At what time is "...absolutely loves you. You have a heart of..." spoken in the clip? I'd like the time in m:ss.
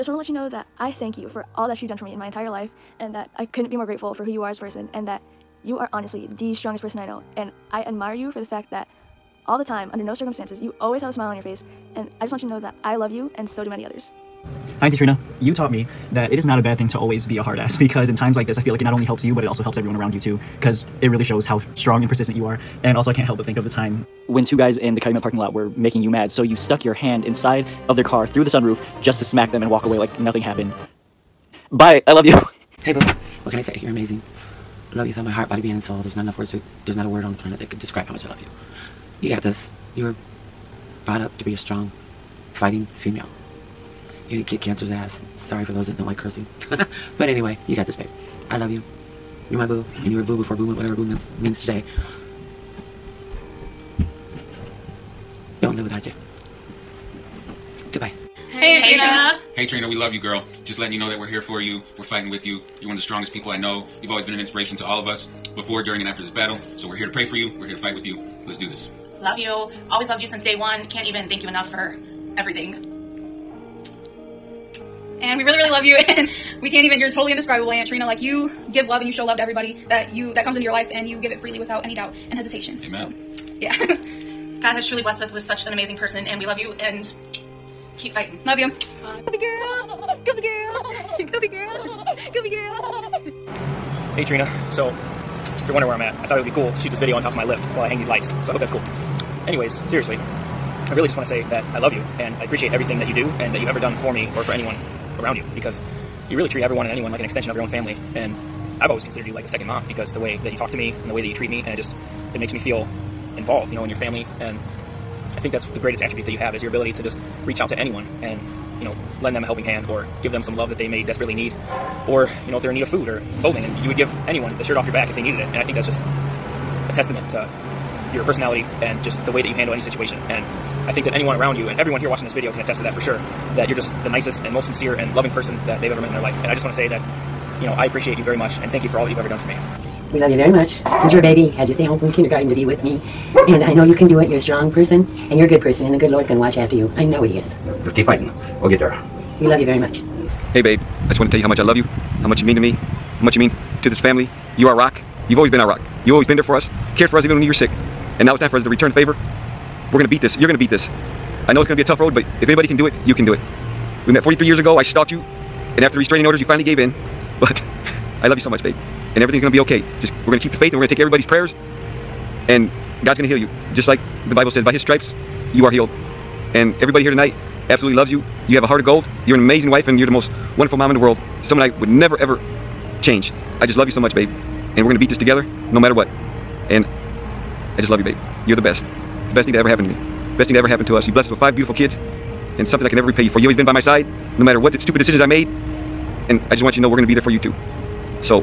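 2:57.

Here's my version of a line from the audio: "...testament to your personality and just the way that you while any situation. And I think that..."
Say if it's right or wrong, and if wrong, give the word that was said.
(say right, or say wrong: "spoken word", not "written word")
wrong: "handle", not "while".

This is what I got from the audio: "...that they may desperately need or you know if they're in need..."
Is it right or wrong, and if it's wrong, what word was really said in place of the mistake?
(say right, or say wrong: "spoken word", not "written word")
right.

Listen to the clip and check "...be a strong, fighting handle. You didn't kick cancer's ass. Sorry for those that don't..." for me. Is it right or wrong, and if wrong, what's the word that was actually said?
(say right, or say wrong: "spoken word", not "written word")
wrong: "female", not "handle".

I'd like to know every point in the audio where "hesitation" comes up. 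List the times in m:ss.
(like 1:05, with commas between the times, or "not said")
1:22.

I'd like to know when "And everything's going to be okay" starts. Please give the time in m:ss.
2:49.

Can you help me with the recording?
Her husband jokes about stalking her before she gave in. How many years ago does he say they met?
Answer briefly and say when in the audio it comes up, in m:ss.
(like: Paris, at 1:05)
43, at 2:44.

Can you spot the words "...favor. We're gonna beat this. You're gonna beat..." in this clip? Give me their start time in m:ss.
2:38.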